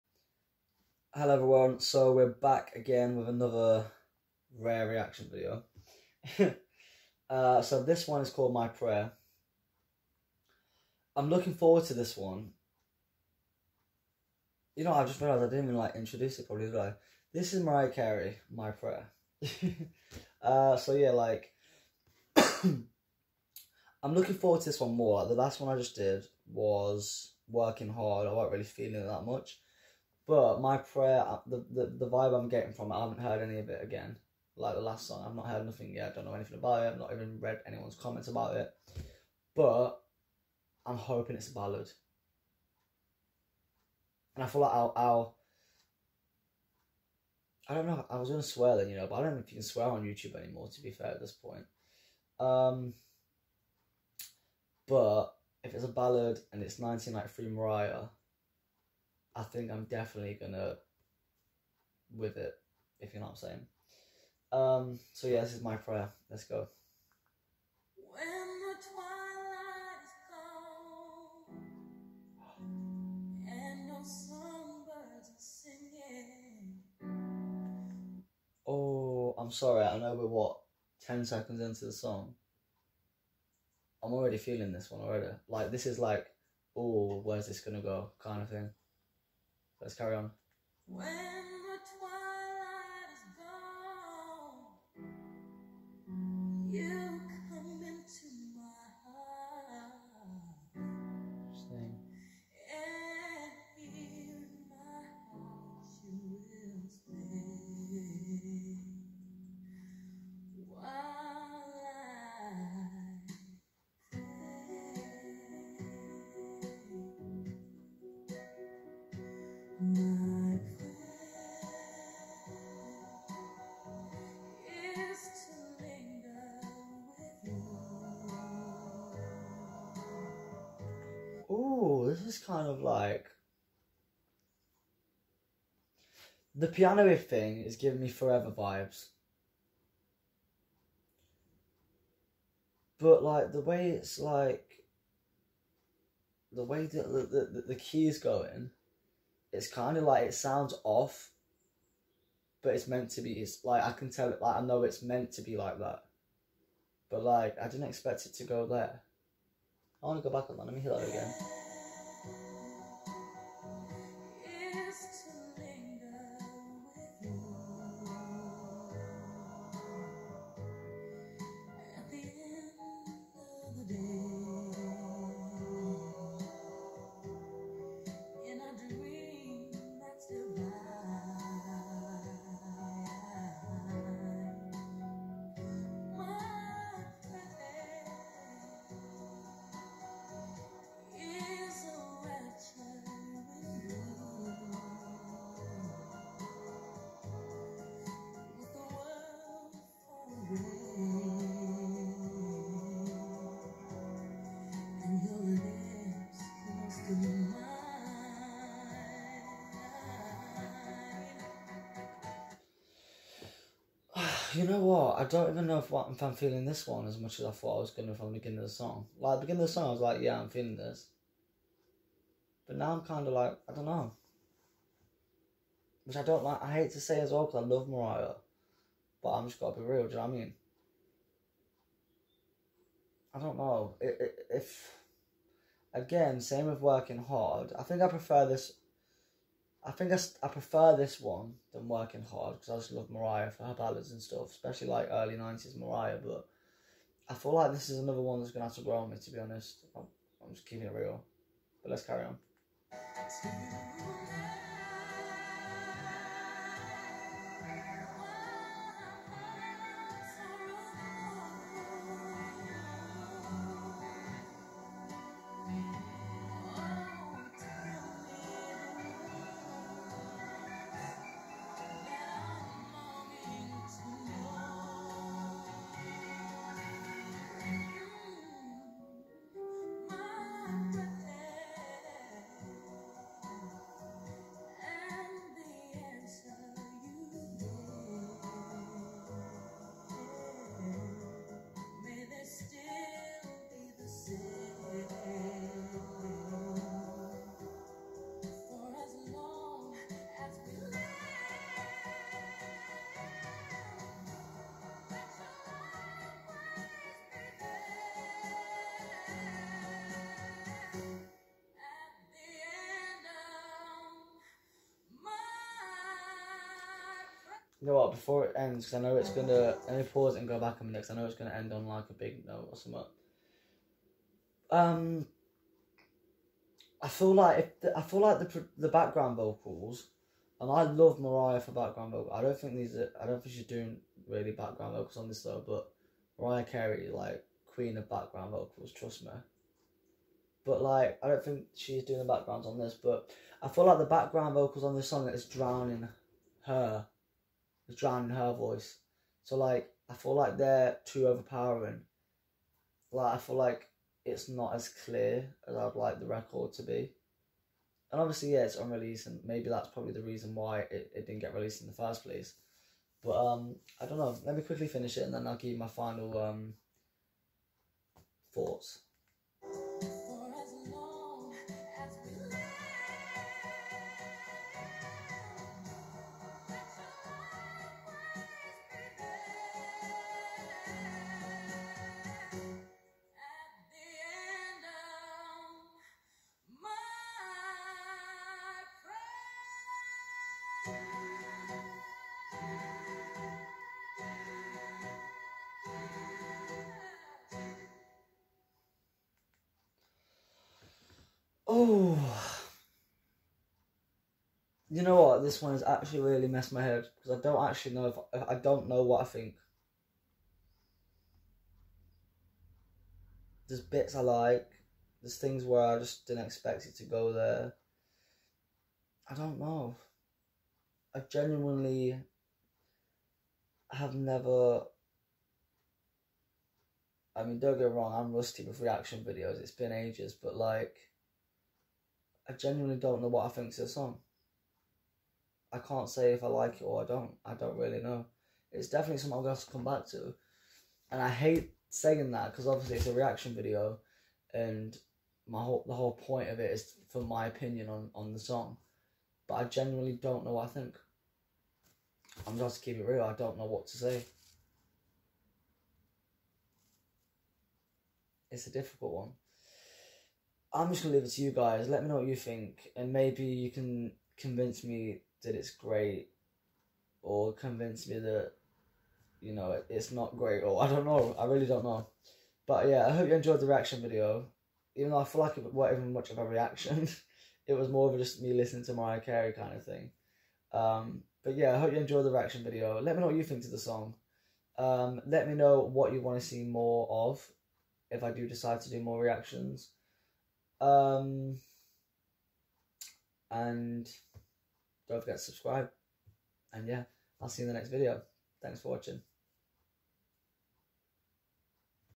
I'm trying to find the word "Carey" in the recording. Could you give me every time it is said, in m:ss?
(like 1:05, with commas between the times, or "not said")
0:17, 5:36, 7:59.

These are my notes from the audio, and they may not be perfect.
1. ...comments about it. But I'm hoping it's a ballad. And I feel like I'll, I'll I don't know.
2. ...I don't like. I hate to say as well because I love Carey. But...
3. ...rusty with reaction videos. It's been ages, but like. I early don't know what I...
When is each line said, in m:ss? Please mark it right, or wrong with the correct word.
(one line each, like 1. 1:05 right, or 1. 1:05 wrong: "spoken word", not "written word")
1. 0:37 right
2. 3:46 wrong: "Mariah", not "Carey"
3. 7:08 wrong: "genuinely", not "early".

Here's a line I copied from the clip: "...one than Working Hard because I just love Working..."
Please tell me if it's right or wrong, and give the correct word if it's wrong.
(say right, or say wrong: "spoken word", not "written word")
wrong: "Mariah", not "Working".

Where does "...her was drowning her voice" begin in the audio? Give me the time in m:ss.
5:46.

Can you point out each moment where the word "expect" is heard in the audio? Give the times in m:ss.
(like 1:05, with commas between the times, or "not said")
2:37, 6:56.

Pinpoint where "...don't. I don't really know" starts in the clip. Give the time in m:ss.
7:17.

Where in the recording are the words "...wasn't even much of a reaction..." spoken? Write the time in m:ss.
7:55.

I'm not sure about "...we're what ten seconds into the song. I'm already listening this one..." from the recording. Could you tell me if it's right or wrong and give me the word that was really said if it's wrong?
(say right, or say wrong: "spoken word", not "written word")
wrong: "feeling", not "listening".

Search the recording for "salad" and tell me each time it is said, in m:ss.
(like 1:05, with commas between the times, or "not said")
not said.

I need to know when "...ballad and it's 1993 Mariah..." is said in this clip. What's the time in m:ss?
0:55.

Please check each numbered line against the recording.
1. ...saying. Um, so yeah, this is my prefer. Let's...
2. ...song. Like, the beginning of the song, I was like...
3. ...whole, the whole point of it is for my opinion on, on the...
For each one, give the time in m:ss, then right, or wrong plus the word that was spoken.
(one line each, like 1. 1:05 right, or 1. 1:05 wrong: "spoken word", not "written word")
1. 1:03 wrong: "prayer", not "prefer"
2. 3:38 right
3. 7:25 right.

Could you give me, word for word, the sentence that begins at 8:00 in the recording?
Um, but yeah, I hope you enjoyed the reaction video.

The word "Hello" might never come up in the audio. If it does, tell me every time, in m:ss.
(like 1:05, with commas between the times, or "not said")
0:01.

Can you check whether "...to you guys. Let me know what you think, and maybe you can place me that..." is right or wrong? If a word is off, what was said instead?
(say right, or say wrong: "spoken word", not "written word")
wrong: "convince", not "place".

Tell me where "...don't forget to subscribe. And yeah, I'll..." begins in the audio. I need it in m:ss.
8:15.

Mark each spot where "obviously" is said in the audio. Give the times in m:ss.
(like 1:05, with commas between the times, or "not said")
5:58, 7:22.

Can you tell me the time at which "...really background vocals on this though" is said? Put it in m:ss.
5:34.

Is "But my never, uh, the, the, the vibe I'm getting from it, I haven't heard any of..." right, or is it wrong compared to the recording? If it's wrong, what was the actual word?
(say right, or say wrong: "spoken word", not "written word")
wrong: "prayer", not "never".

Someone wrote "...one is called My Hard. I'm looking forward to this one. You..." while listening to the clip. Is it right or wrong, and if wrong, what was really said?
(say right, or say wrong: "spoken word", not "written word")
wrong: "Prayer", not "Hard".